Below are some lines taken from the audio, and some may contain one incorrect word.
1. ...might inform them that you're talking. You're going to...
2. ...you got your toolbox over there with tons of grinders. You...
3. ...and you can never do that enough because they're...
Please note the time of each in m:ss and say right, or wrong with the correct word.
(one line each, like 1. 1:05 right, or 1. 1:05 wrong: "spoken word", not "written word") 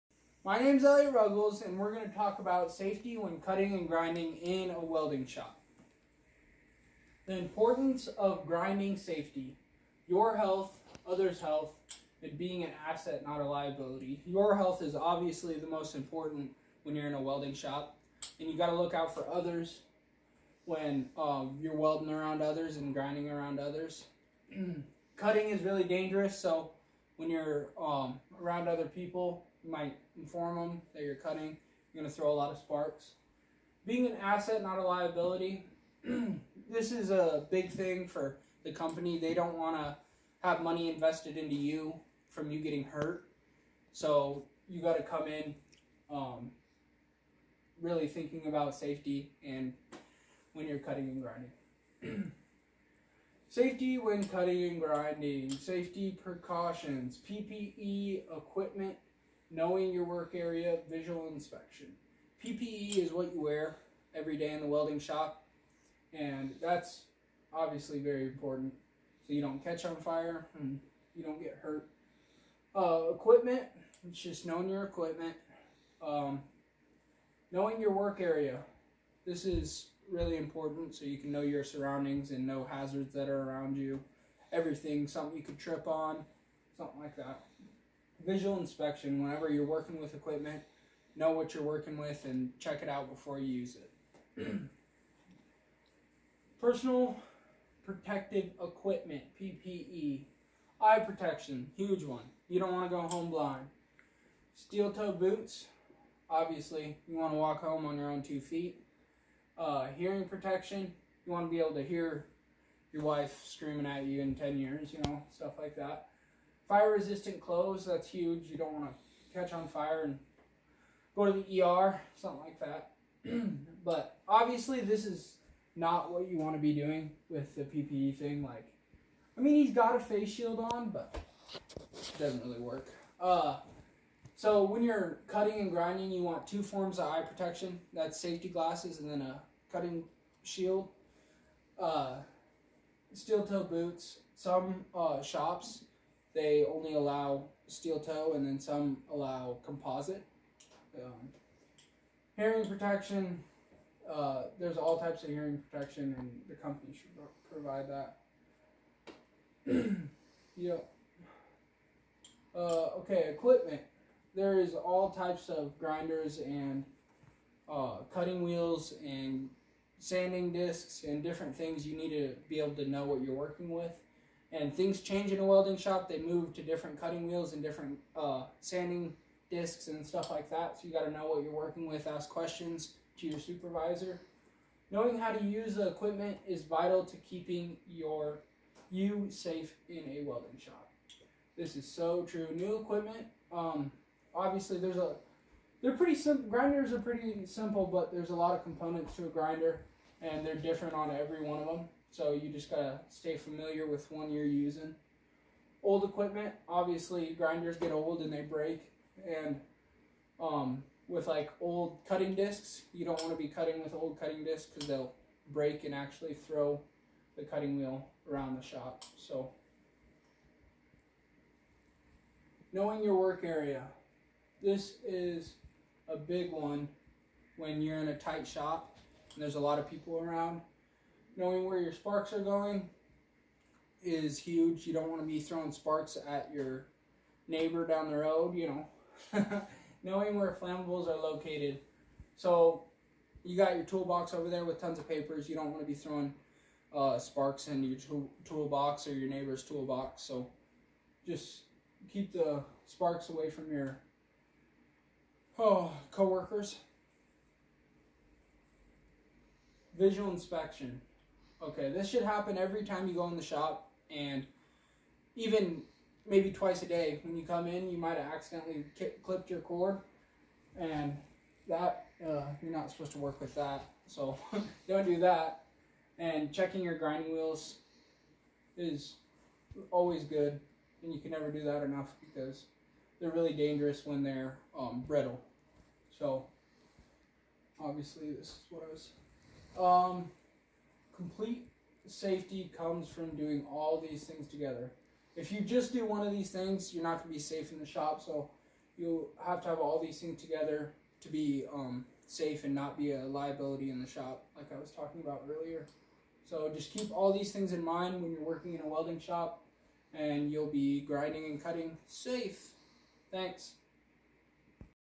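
1. 0:29 wrong: "cutting", not "talking"
2. 4:03 wrong: "papers", not "grinders"
3. 4:41 right.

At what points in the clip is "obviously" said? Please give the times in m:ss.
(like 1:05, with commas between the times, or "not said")
0:14, 1:07, 1:46, 2:04, 3:14, 3:26, 4:47.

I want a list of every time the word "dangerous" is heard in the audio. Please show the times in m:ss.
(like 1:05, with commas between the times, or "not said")
0:25, 4:43.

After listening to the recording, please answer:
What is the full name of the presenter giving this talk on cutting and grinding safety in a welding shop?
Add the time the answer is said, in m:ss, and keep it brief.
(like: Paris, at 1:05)
Elliot Ruggles, at 0:00.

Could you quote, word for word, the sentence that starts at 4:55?
If you just do one of these things, you're not going to be safe in the shop.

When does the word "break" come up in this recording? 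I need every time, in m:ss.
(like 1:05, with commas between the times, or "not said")
3:28, 3:35.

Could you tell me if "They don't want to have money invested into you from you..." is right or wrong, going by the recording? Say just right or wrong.
right.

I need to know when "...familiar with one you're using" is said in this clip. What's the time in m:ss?
3:23.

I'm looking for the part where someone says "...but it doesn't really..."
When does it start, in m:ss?
2:10.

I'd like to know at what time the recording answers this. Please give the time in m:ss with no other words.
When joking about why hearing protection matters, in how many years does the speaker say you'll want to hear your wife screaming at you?
1:54.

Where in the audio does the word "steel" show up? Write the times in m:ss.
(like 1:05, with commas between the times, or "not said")
1:44, 2:23, 2:27.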